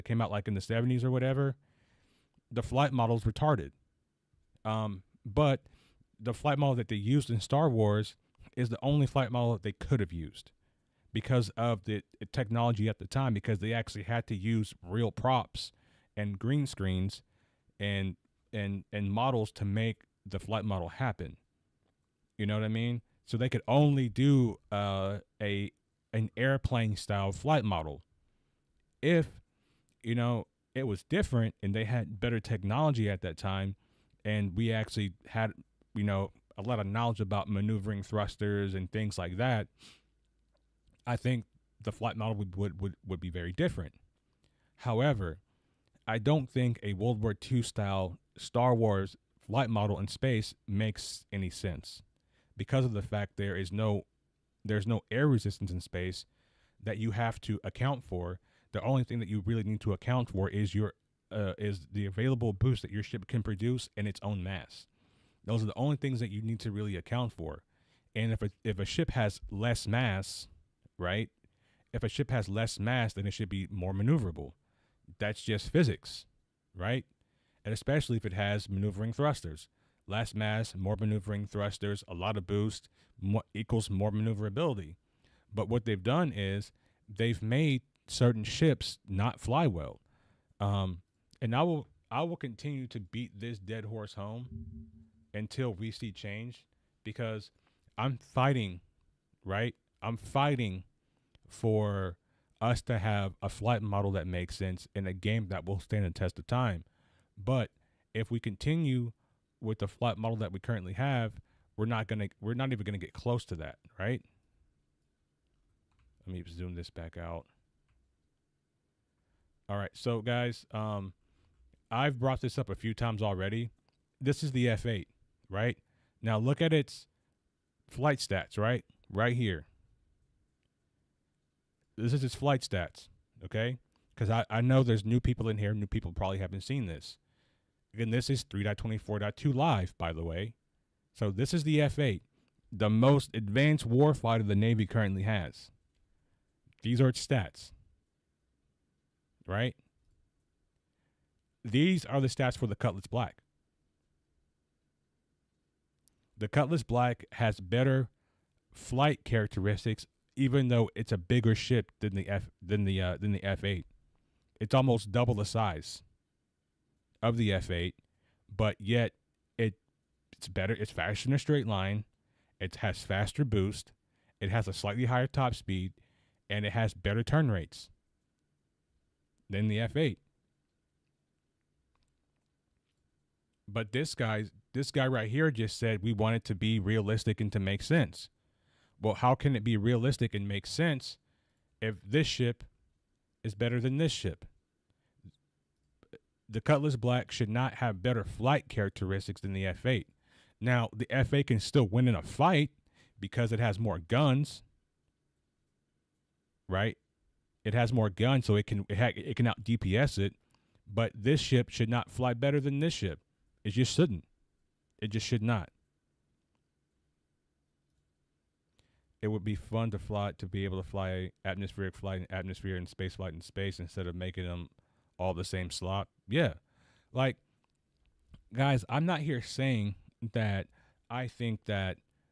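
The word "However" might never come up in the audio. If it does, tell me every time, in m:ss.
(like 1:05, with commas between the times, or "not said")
0:44.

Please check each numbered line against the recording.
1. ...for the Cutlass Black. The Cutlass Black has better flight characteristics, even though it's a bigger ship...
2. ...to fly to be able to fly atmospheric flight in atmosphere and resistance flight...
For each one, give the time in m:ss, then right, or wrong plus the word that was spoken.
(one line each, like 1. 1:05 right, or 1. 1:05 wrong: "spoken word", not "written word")
1. 2:32 right
2. 3:39 wrong: "space", not "resistance".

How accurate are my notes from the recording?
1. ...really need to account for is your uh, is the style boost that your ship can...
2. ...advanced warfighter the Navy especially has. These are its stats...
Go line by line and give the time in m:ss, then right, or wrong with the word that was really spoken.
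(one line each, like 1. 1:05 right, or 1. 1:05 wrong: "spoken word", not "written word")
1. 0:59 wrong: "available", not "style"
2. 2:23 wrong: "currently", not "especially".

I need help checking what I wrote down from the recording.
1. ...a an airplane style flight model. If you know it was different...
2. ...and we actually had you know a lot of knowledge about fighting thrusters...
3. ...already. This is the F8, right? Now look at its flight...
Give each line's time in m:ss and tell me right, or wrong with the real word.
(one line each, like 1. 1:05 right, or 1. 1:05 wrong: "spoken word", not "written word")
1. 0:25 right
2. 0:34 wrong: "maneuvering", not "fighting"
3. 2:03 right.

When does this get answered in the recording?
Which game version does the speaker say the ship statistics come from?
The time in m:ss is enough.
2:18.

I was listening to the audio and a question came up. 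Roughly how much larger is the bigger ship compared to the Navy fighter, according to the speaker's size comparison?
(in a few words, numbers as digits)
almost double.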